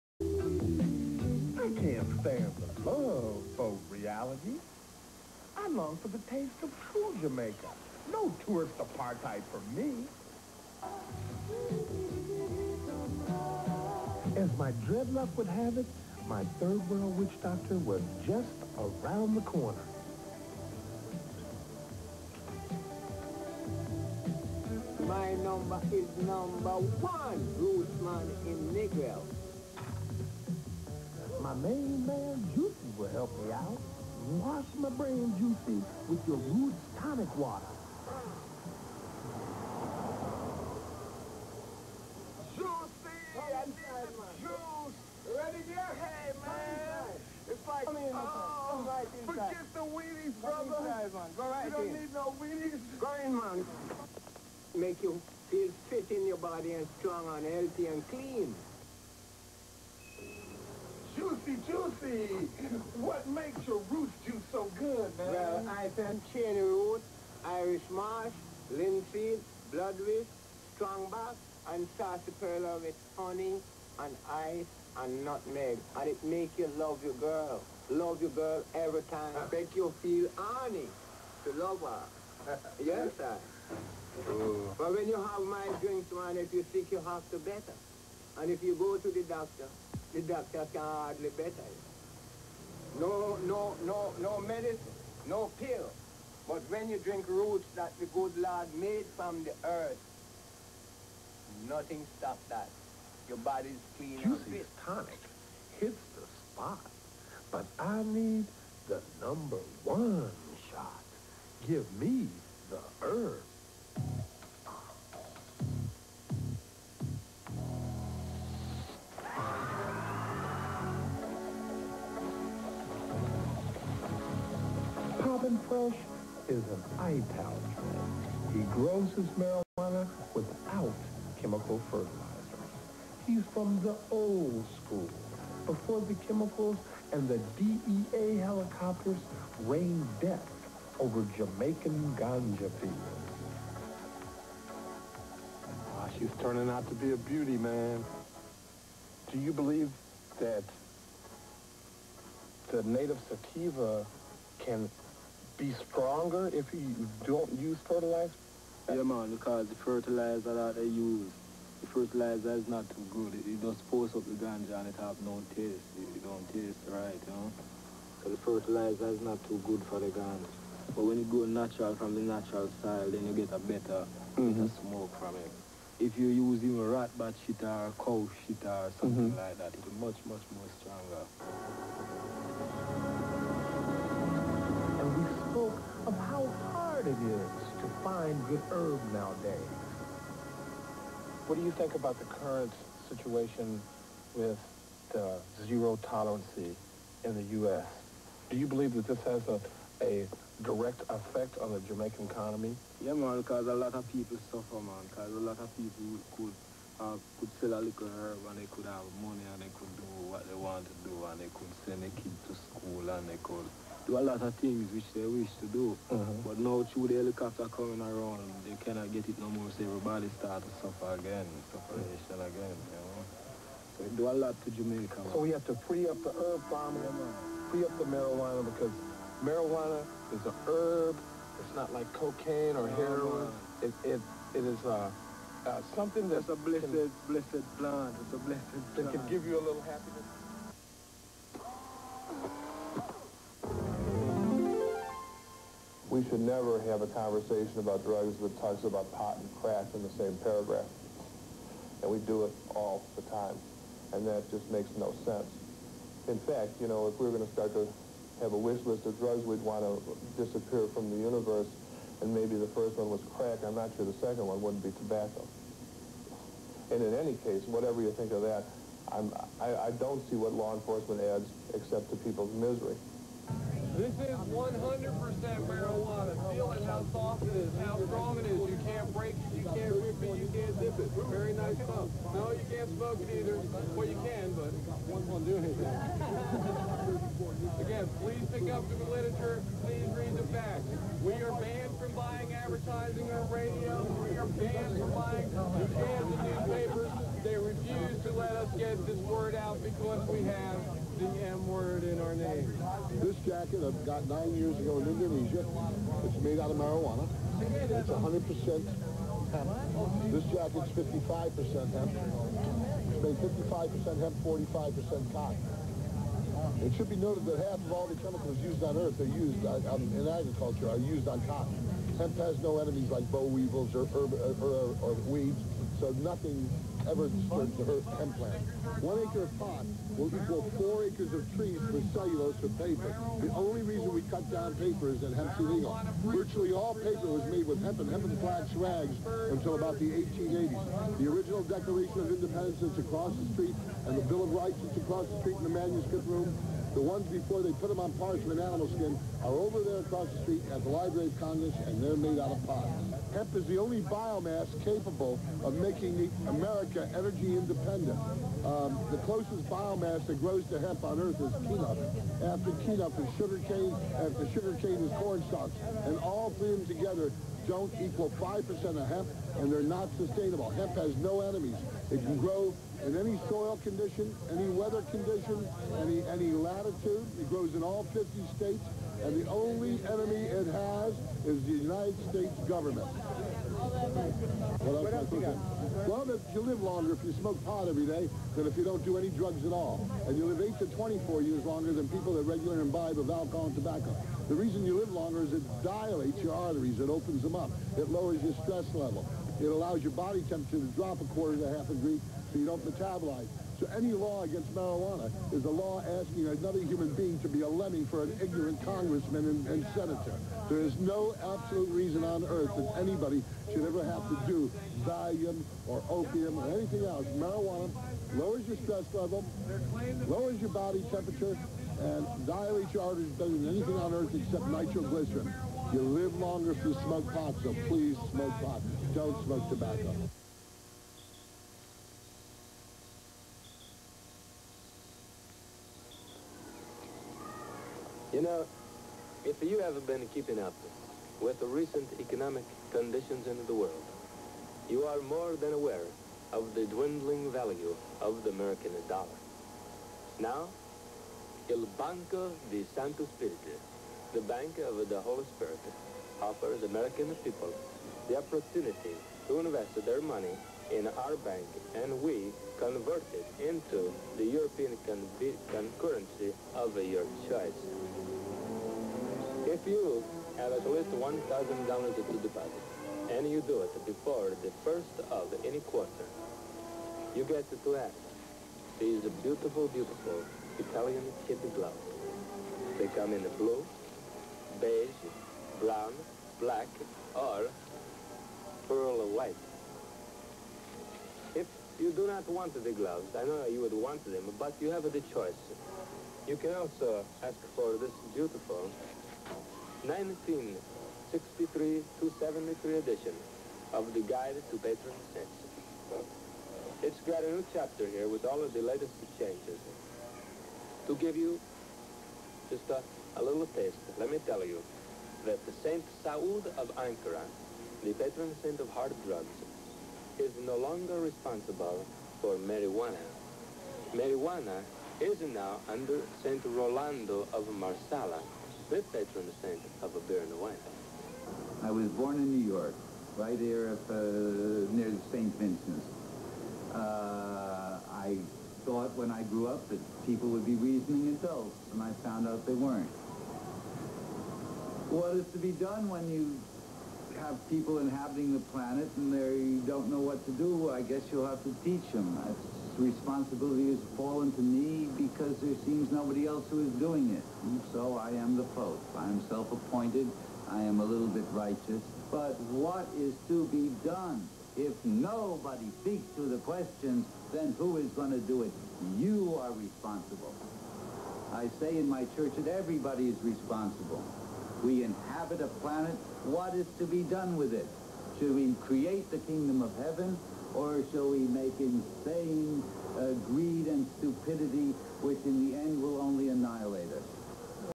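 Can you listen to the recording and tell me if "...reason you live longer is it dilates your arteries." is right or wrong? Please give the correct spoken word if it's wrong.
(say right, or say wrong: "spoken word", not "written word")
right.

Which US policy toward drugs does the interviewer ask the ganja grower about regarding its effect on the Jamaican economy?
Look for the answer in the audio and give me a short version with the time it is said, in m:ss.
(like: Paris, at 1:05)
zero tolerance, at 3:15.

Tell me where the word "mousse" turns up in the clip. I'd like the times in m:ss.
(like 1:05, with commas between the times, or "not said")
not said.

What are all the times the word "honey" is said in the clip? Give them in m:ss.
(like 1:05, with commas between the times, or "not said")
1:13, 1:20.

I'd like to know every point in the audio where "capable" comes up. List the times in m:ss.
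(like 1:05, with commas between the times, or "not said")
5:54.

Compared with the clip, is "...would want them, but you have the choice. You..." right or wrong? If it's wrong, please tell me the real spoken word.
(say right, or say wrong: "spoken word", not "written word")
right.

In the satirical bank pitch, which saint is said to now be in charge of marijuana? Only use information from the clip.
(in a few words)
Saint Rolando of Marsala.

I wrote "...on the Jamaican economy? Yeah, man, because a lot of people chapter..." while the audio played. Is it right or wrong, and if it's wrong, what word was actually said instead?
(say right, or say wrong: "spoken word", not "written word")
wrong: "suffer", not "chapter".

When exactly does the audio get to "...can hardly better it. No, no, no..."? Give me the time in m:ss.
1:30.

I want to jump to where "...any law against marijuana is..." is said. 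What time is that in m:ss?
6:43.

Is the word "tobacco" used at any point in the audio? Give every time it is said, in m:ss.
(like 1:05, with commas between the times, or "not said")
4:24, 6:33, 7:09.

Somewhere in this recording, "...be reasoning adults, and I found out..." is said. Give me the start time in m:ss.
9:00.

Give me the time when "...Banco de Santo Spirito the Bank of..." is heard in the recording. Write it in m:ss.
7:31.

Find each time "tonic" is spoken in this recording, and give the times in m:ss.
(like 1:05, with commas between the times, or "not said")
0:36, 1:44.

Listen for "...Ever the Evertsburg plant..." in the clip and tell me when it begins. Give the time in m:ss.
5:27.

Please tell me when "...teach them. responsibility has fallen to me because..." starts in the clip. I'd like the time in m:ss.
9:11.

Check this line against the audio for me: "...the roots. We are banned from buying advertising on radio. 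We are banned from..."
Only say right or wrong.
wrong.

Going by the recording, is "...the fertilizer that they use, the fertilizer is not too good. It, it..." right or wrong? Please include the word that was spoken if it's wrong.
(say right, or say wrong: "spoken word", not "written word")
right.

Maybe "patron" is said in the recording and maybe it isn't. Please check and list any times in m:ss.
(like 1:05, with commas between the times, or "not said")
8:24, 8:38, 8:49.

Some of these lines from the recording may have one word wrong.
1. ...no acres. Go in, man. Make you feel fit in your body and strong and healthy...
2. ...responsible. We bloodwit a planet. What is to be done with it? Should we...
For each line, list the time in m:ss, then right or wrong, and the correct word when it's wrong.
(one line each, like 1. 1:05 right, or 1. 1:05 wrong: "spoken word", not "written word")
1. 0:52 wrong: "weenies", not "acres"
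2. 9:33 wrong: "inhabit", not "bloodwit".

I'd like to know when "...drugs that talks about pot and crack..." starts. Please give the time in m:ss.
4:08.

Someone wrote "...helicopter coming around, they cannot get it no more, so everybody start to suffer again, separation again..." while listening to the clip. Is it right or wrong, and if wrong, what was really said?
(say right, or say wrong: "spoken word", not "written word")
right.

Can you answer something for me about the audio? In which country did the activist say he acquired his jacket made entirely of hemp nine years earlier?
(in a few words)
Indonesia.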